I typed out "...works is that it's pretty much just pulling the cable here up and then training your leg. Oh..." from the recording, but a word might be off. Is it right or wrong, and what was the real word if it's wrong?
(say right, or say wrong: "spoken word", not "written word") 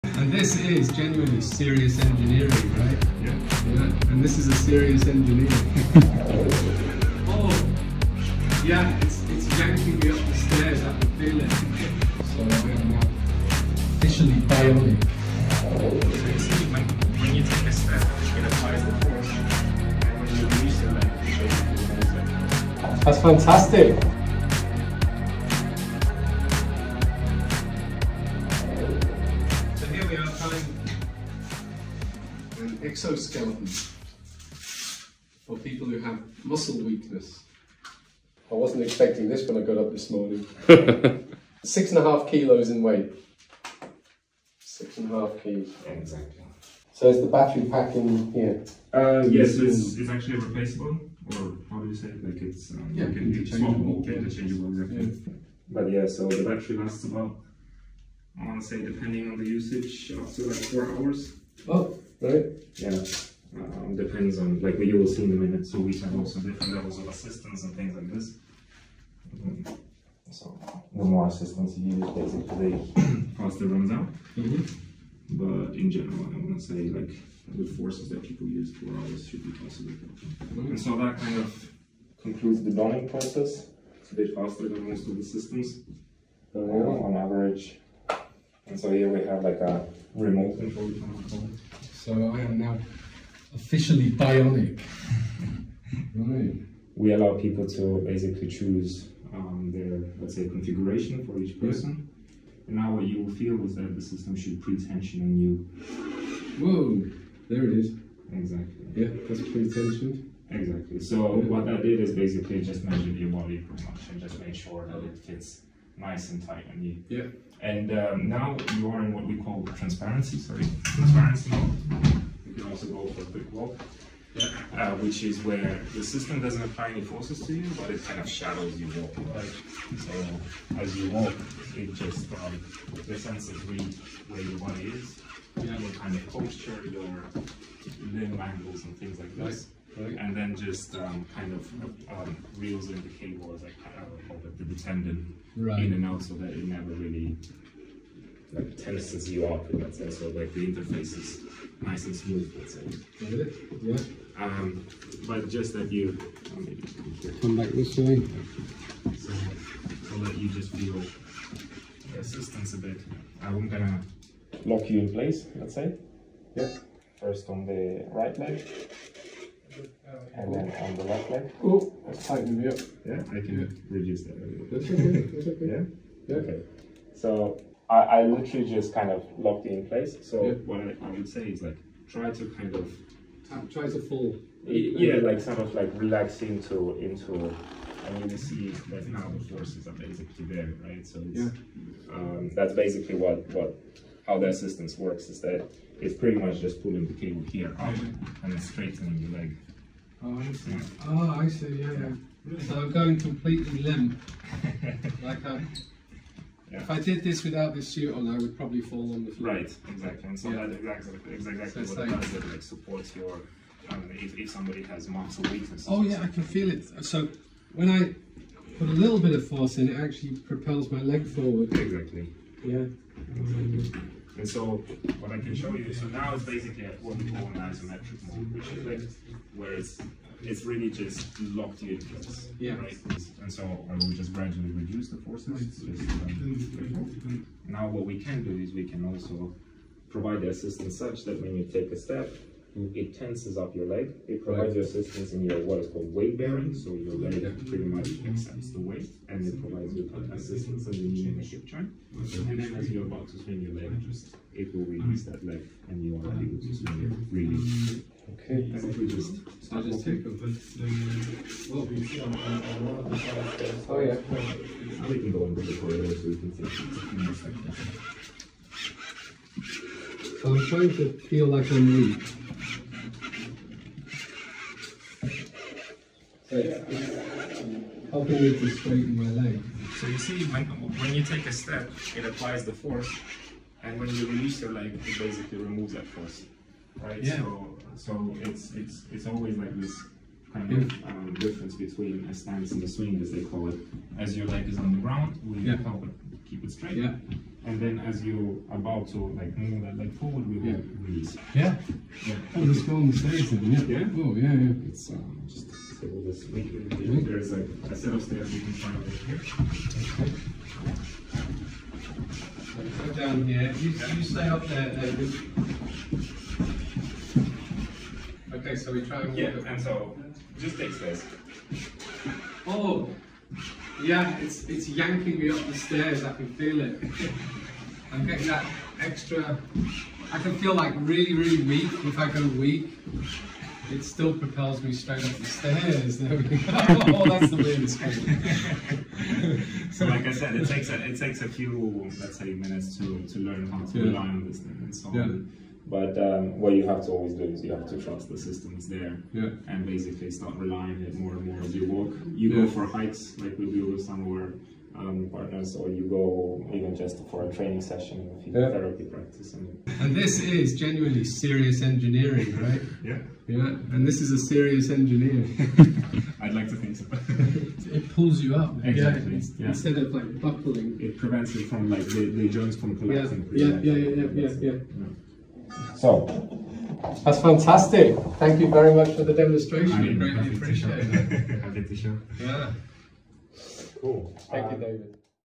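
wrong: "straightening", not "training".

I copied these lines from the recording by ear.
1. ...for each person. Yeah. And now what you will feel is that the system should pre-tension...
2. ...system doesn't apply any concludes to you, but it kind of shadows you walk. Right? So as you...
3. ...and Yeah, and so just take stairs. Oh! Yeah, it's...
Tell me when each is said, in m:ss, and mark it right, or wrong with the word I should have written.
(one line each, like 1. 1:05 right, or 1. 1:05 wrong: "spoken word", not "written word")
1. 1:41 right
2. 2:06 wrong: "forces", not "concludes"
3. 5:19 right.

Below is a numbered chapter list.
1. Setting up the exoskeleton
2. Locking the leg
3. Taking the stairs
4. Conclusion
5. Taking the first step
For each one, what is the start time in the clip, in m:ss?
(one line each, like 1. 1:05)
1. 0:30
2. 2:44
3. 5:07
4. 5:47
5. 2:03.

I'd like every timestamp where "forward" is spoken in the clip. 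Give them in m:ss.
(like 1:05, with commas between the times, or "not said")
3:41, 5:00.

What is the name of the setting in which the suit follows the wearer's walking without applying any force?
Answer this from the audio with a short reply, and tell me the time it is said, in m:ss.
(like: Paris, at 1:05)
transparency mode, at 2:00.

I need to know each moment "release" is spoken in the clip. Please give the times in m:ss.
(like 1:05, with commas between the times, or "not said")
4:14, 4:44, 5:00.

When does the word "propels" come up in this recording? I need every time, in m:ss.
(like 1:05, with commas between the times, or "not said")
3:40, 5:34.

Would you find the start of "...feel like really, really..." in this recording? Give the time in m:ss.
5:30.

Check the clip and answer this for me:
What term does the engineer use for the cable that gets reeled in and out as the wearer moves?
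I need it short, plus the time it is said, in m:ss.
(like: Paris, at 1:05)
tendon, at 2:24.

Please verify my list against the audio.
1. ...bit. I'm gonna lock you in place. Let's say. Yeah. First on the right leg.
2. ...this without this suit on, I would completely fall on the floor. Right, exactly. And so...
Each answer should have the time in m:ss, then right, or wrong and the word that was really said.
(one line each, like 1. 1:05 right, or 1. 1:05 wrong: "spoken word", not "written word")
1. 2:42 right
2. 3:27 wrong: "probably", not "completely".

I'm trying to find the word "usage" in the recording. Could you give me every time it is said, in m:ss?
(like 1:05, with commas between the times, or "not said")
0:59.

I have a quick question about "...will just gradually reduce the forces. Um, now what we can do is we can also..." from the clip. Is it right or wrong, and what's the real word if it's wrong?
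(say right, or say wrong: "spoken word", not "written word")
right.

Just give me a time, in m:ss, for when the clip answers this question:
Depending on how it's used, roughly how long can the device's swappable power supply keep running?
1:00.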